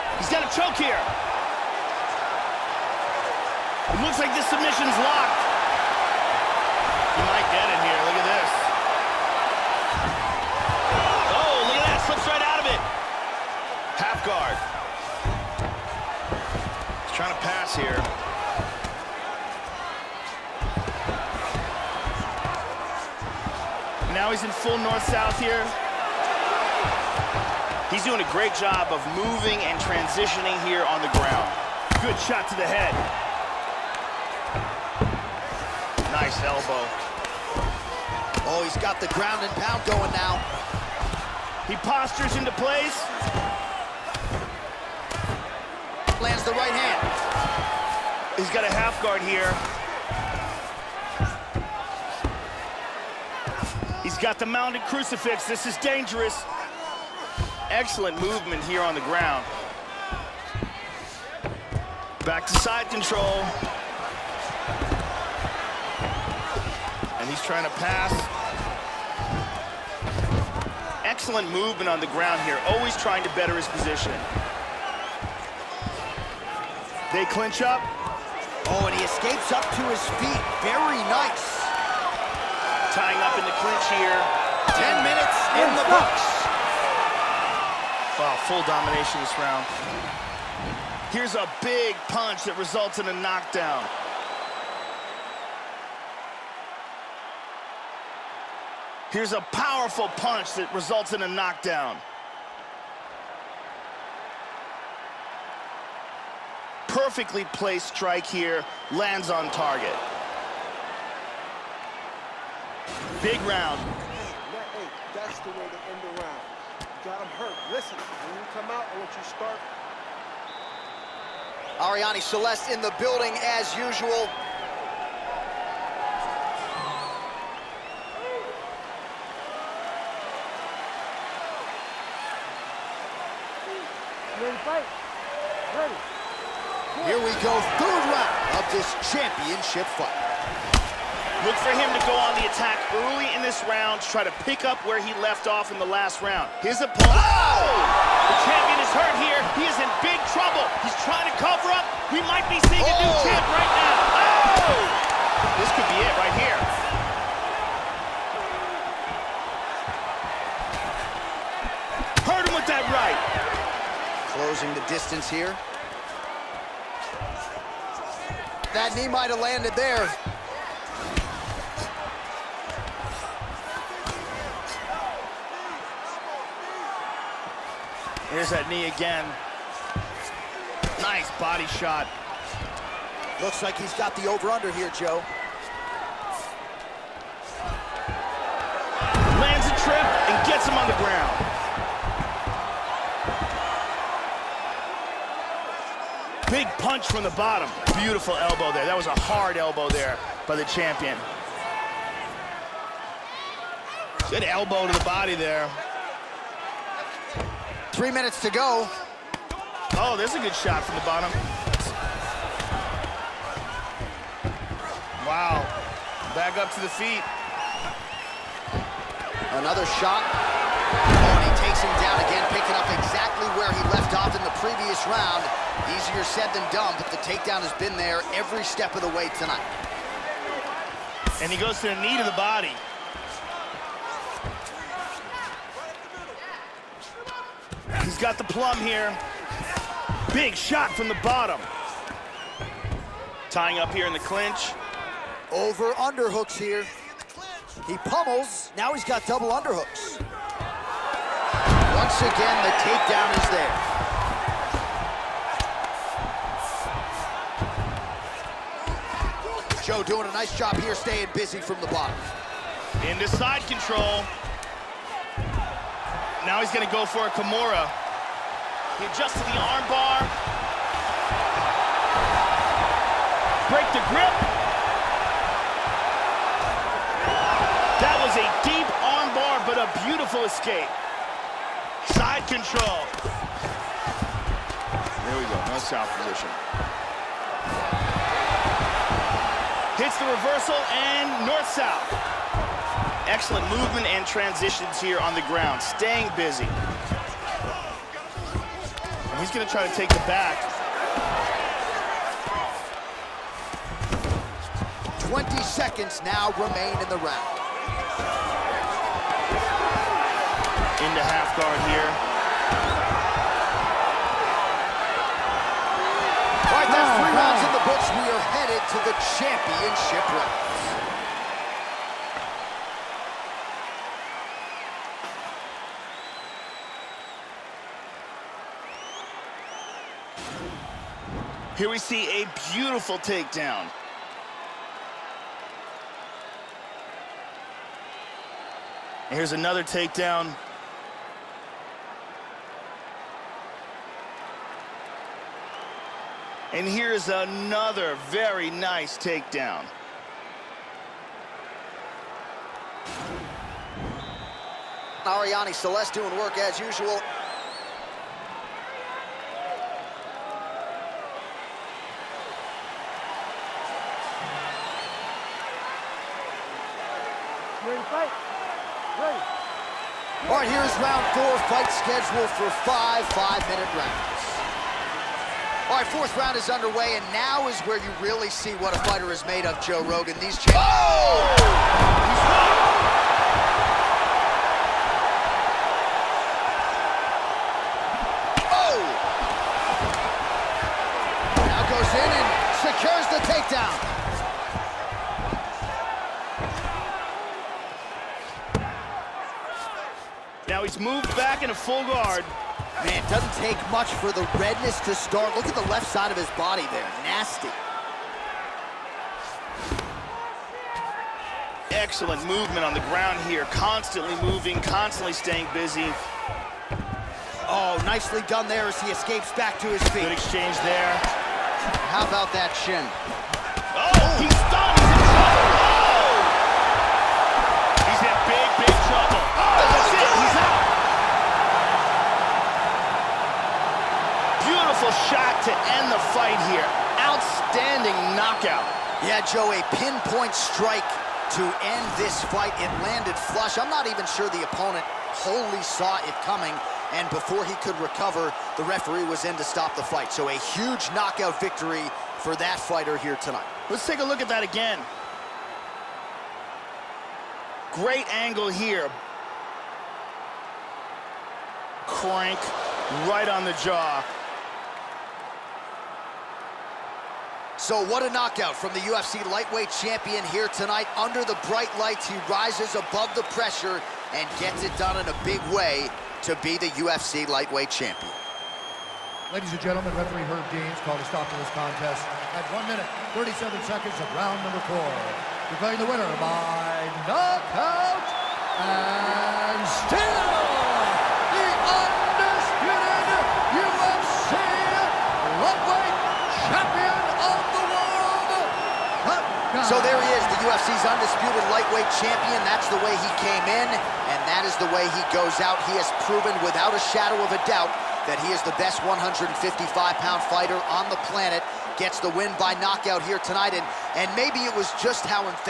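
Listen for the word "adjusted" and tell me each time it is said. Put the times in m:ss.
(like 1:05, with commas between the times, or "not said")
4:29.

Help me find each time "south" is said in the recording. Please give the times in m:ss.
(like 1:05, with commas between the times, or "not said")
0:24, 4:45, 4:51.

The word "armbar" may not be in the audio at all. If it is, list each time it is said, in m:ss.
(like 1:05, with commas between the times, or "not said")
4:29, 4:39.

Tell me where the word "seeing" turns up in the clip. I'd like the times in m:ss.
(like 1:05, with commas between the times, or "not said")
2:32.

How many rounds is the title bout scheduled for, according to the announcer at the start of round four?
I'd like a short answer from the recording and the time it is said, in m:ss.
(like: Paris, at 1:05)
5, at 6:12.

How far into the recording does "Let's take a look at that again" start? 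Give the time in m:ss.
7:33.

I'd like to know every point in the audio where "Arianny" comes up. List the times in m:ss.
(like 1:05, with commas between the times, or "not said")
2:01, 5:55.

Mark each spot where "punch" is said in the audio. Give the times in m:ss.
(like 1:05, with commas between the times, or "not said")
1:32, 1:40, 3:16.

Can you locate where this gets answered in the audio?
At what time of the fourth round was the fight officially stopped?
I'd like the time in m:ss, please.
8:02.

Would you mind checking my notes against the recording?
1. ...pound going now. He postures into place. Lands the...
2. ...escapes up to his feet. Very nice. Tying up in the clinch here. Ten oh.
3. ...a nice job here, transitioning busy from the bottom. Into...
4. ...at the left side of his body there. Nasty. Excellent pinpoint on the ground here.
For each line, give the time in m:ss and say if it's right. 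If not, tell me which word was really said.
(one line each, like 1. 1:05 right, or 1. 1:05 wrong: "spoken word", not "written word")
1. 0:39 right
2. 1:19 right
3. 4:20 wrong: "staying", not "transitioning"
4. 6:45 wrong: "movement", not "pinpoint".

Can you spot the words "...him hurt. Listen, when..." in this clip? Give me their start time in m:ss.
1:57.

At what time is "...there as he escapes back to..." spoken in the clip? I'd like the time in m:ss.
6:58.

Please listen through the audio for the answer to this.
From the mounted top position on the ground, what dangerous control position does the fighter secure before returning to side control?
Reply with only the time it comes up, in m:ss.
0:54.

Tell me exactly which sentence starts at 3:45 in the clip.
Easier said than done, but the takedown has been there every step of the way tonight.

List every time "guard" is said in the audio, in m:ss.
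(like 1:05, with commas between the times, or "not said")
0:49, 5:11, 6:42.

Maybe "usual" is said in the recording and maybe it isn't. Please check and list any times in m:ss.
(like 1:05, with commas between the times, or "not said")
2:03, 5:56.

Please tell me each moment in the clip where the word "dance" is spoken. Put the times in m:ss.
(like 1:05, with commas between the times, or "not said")
not said.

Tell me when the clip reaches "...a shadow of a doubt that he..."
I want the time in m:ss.
8:26.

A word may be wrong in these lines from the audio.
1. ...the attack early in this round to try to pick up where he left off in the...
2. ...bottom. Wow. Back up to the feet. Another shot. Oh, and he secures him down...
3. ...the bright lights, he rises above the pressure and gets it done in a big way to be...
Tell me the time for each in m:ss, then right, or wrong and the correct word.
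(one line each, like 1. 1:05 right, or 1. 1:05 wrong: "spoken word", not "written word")
1. 2:22 right
2. 3:31 wrong: "takes", not "secures"
3. 7:51 right.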